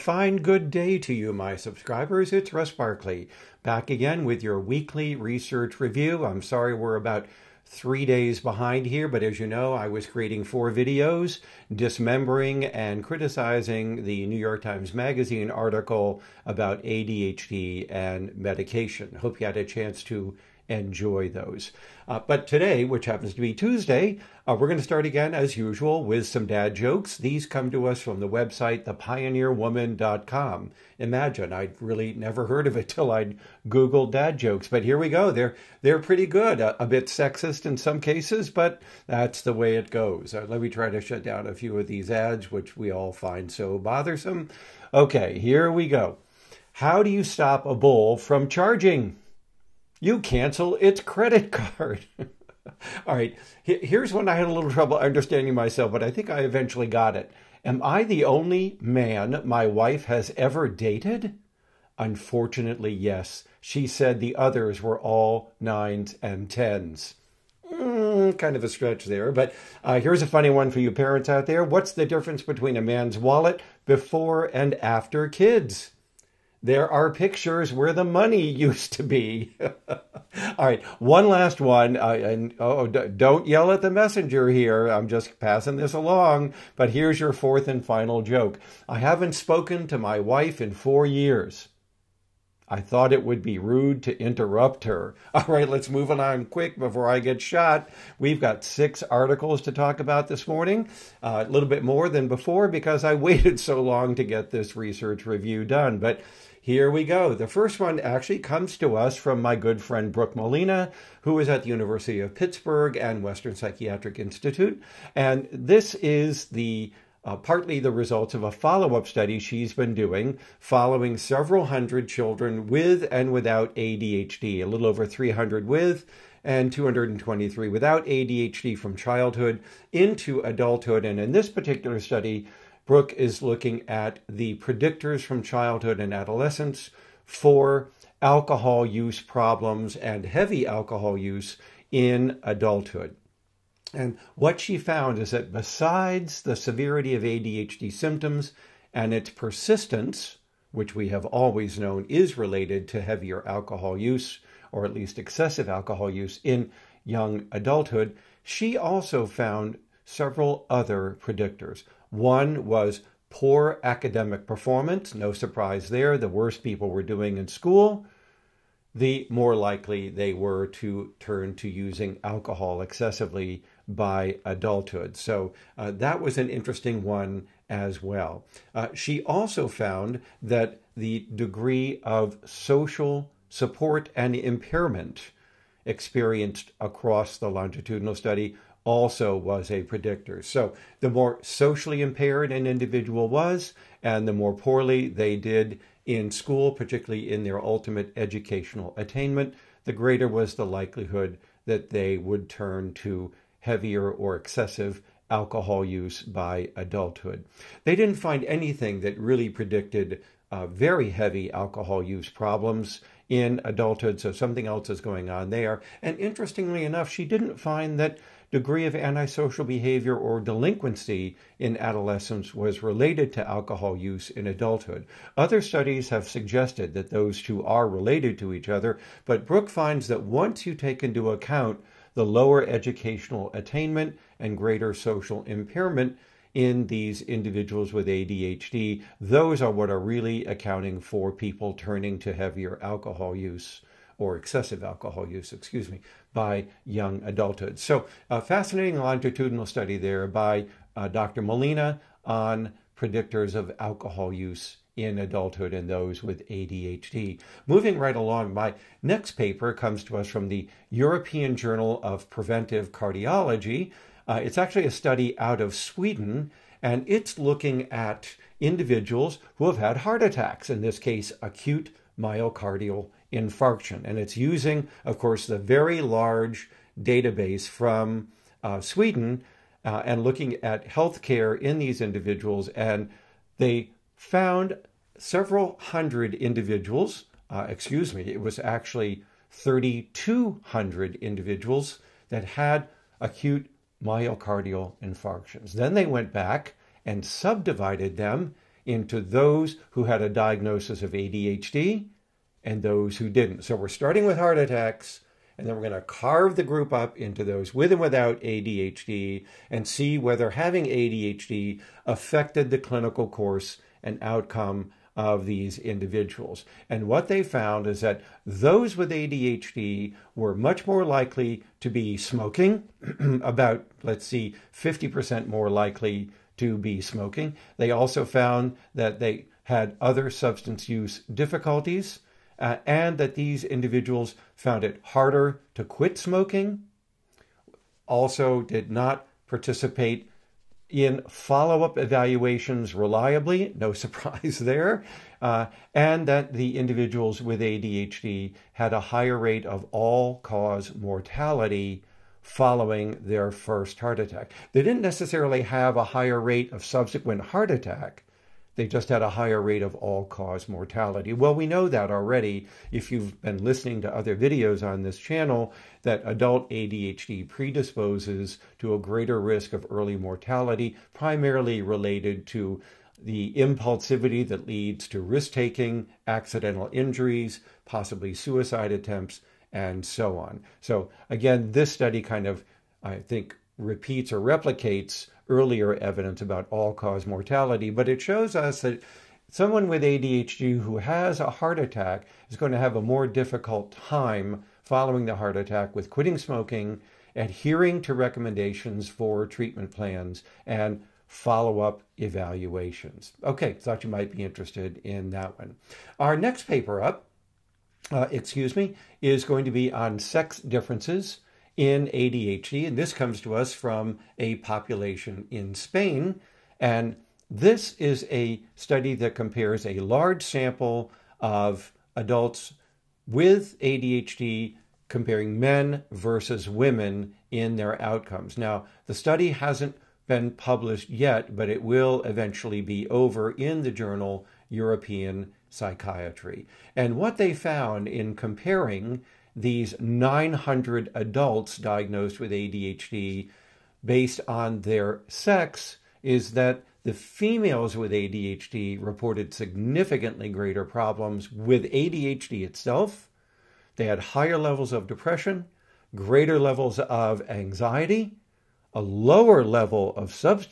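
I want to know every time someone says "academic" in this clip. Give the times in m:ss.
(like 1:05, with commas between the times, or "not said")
2:43.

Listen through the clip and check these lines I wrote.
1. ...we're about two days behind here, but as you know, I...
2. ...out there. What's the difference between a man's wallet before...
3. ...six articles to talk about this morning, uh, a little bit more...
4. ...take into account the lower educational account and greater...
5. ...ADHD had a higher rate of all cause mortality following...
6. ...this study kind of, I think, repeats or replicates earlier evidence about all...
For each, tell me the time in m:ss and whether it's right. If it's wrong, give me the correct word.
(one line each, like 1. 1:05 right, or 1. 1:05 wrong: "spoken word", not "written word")
1. 0:06 wrong: "three", not "two"
2. 1:11 right
3. 1:38 right
4. 3:50 wrong: "attainment", not "account"
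5. 5:47 right
6. 6:21 right.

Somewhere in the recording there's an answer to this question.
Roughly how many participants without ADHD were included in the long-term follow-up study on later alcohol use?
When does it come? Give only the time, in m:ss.
2:06.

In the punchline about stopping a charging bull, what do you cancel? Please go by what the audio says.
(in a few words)
its credit card.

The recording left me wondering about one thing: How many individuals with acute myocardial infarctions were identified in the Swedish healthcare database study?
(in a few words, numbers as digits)
3,200.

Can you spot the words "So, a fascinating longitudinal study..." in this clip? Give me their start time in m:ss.
4:07.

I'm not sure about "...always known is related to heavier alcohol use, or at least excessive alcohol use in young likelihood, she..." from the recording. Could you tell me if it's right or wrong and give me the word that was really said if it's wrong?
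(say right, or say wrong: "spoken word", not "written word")
wrong: "adulthood", not "likelihood".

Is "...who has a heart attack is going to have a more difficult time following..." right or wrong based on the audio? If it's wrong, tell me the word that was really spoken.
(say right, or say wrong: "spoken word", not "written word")
right.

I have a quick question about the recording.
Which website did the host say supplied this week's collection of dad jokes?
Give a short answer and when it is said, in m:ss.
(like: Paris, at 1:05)
thepioneerwoman.com, at 0:28.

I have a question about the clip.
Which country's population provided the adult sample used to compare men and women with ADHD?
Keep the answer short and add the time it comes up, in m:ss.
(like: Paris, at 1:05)
Spain, at 6:55.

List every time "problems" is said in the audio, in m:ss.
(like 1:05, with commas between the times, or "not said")
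2:19, 3:32, 7:30.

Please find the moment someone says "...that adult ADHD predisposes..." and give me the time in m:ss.
6:06.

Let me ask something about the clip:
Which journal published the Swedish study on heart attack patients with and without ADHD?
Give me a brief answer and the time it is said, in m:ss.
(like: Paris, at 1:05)
European Journal of Preventive Cardiology, at 4:20.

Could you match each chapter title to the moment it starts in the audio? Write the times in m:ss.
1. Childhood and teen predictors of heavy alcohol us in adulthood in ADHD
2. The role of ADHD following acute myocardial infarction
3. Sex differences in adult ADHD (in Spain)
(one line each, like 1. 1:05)
1. 1:47
2. 4:18
3. 6:45.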